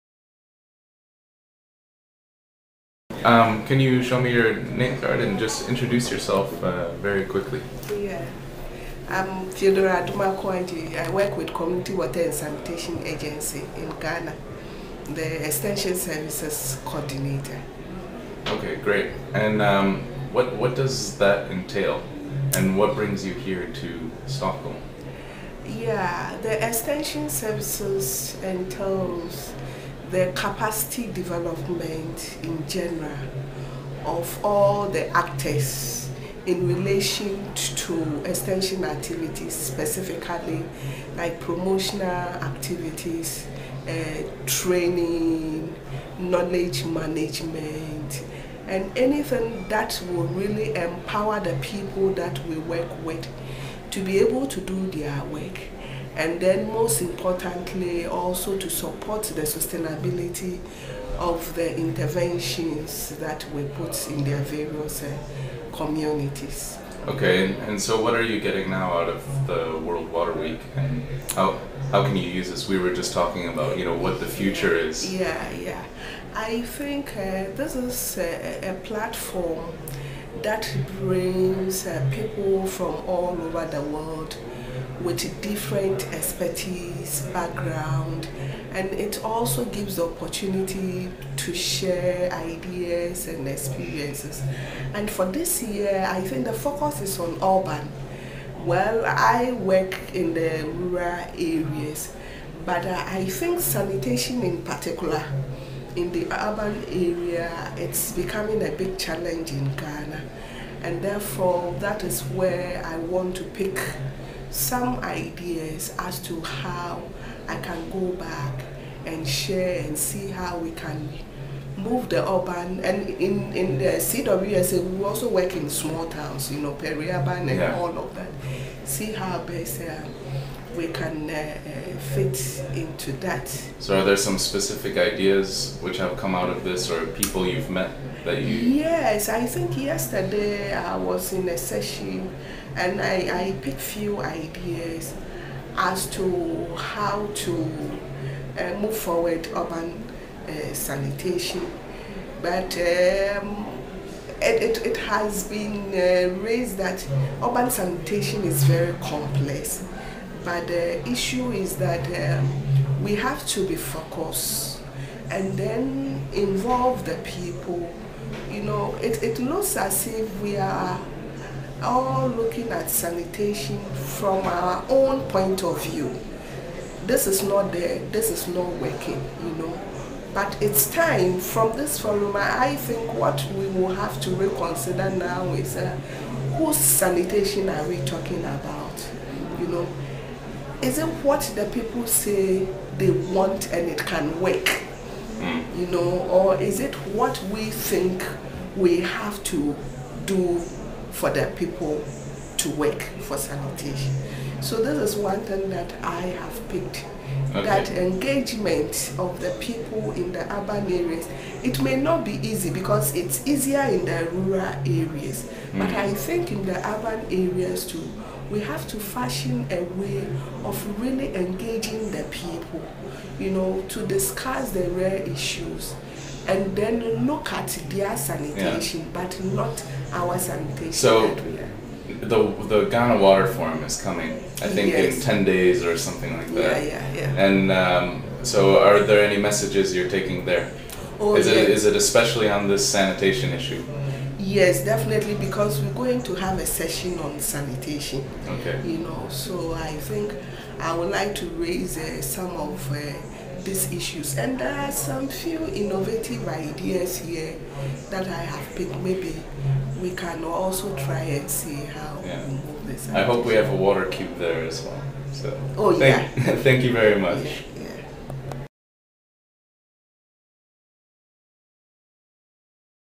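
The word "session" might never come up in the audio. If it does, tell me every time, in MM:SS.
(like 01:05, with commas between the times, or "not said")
02:21, 04:06.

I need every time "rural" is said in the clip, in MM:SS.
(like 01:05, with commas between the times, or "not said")
01:40, 03:34.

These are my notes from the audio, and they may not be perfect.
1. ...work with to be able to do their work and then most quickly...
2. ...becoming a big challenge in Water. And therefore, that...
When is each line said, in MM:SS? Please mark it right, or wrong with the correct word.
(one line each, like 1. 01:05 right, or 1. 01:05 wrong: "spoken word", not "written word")
1. 00:52 wrong: "importantly", not "quickly"
2. 01:48 wrong: "Ghana", not "Water".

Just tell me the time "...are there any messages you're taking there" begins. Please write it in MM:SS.
03:58.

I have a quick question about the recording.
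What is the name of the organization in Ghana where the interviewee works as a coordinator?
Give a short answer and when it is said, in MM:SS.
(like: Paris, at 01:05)
Community Water and Sanitation Agency, at 00:11.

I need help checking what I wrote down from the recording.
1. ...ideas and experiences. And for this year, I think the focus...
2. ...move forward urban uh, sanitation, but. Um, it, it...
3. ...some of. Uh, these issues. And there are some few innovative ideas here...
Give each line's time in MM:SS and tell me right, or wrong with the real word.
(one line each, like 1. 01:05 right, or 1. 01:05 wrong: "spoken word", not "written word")
1. 01:32 right
2. 02:28 right
3. 04:12 right.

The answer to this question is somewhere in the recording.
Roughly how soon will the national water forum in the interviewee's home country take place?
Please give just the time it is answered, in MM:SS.
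03:55.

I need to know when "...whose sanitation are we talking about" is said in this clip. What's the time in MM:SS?
03:06.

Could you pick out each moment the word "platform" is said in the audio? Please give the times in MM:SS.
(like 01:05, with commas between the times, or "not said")
01:18.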